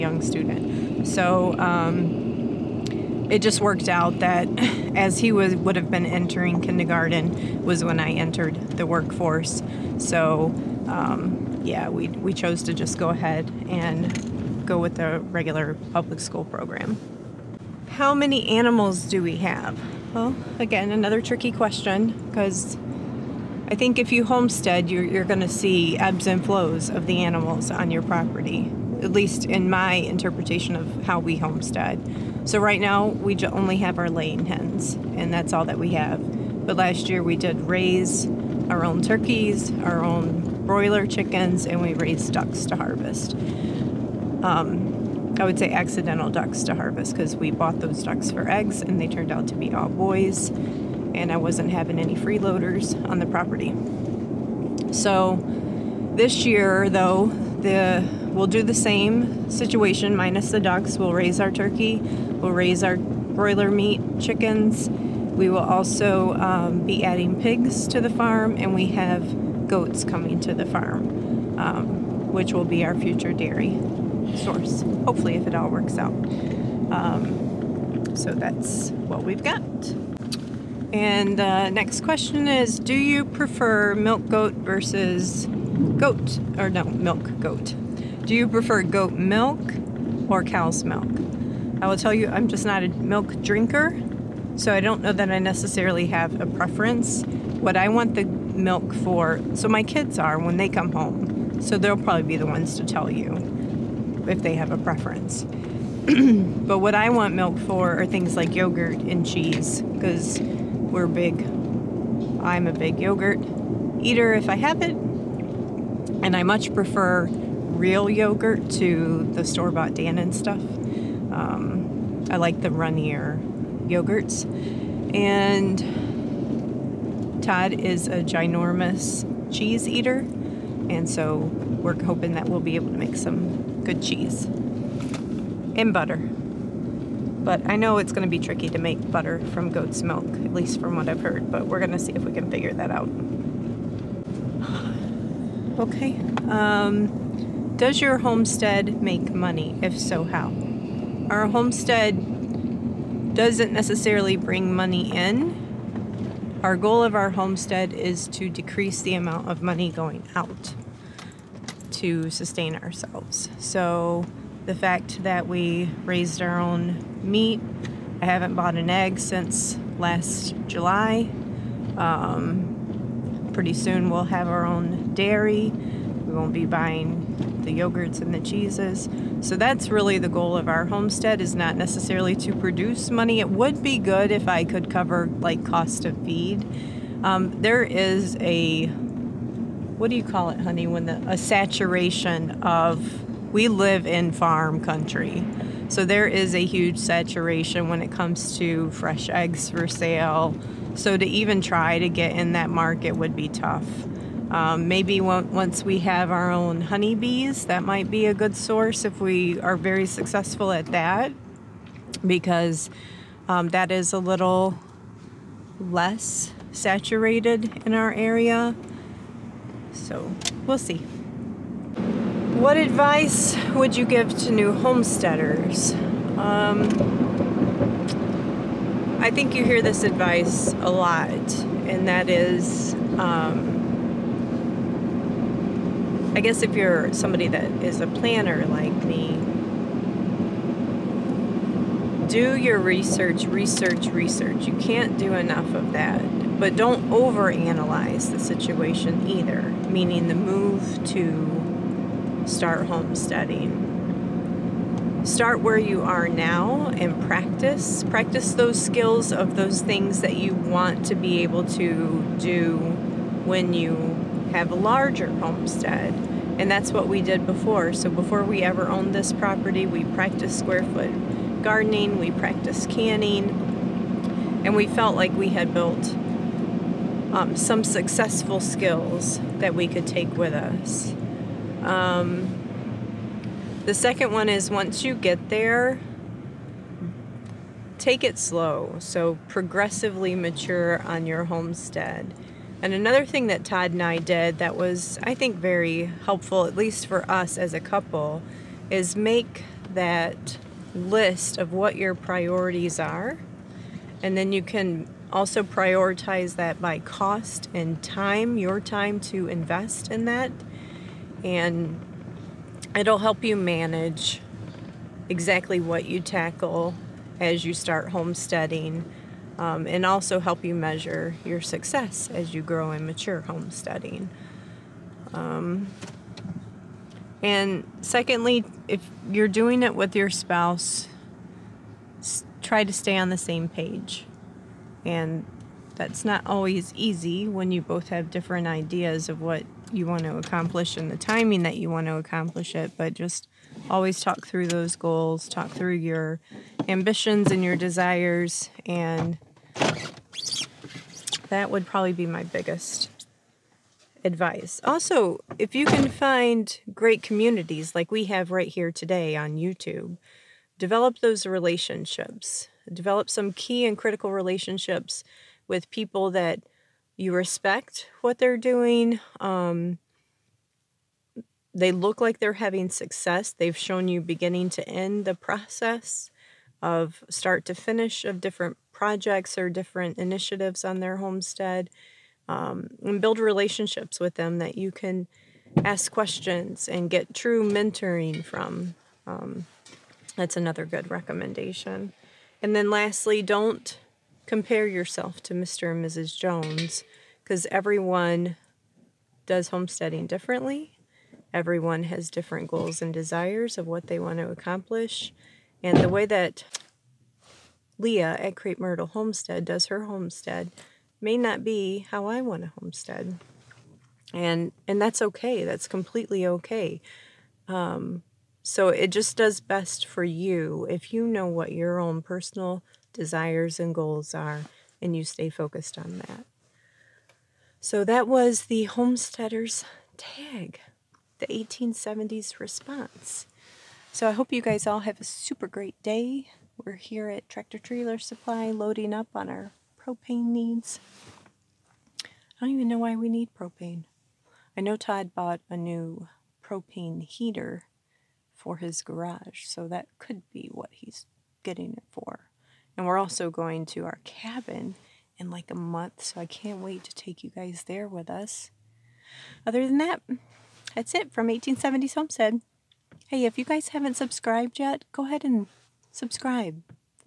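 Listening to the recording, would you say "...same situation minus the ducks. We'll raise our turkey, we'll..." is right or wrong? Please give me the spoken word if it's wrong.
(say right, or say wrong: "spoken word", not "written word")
right.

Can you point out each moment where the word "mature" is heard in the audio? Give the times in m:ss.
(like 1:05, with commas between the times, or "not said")
4:50, 5:23.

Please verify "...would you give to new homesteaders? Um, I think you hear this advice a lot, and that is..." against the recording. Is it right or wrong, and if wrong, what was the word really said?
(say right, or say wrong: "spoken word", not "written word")
right.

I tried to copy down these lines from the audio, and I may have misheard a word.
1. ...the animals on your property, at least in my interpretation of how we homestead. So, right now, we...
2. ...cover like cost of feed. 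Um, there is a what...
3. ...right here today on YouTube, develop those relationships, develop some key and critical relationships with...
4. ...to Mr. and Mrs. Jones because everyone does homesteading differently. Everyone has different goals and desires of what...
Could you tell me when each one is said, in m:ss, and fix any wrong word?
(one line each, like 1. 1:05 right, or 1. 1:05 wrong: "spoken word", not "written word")
1. 0:27 right
2. 3:04 right
3. 5:58 right
4. 6:35 right.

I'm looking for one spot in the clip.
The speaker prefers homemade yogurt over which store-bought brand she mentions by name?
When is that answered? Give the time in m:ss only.
1:59.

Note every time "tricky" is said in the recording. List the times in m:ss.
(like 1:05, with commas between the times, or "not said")
0:21, 2:18.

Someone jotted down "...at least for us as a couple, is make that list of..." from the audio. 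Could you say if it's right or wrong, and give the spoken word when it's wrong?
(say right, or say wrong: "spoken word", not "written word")
right.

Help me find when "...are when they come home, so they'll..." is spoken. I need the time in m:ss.
1:40.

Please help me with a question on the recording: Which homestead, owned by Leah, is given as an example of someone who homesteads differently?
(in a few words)
Crape Myrtle Homestead.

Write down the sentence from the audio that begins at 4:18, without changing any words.
Practice those skills of those things that you want to be able to do when you have a larger homestead.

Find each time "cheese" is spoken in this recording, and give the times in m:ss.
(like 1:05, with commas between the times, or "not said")
1:49, 2:09, 2:14, 2:58.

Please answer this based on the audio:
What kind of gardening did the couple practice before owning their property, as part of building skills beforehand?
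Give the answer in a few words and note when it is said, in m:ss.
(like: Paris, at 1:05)
Square foot gardening, at 4:30.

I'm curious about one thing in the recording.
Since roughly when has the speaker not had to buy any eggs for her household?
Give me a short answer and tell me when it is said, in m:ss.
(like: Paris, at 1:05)
Last July, at 2:49.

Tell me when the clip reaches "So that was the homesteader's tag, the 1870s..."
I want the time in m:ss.
7:07.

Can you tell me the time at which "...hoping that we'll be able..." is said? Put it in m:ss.
2:12.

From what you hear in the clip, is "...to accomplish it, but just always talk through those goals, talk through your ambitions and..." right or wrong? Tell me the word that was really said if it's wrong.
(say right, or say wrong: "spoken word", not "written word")
right.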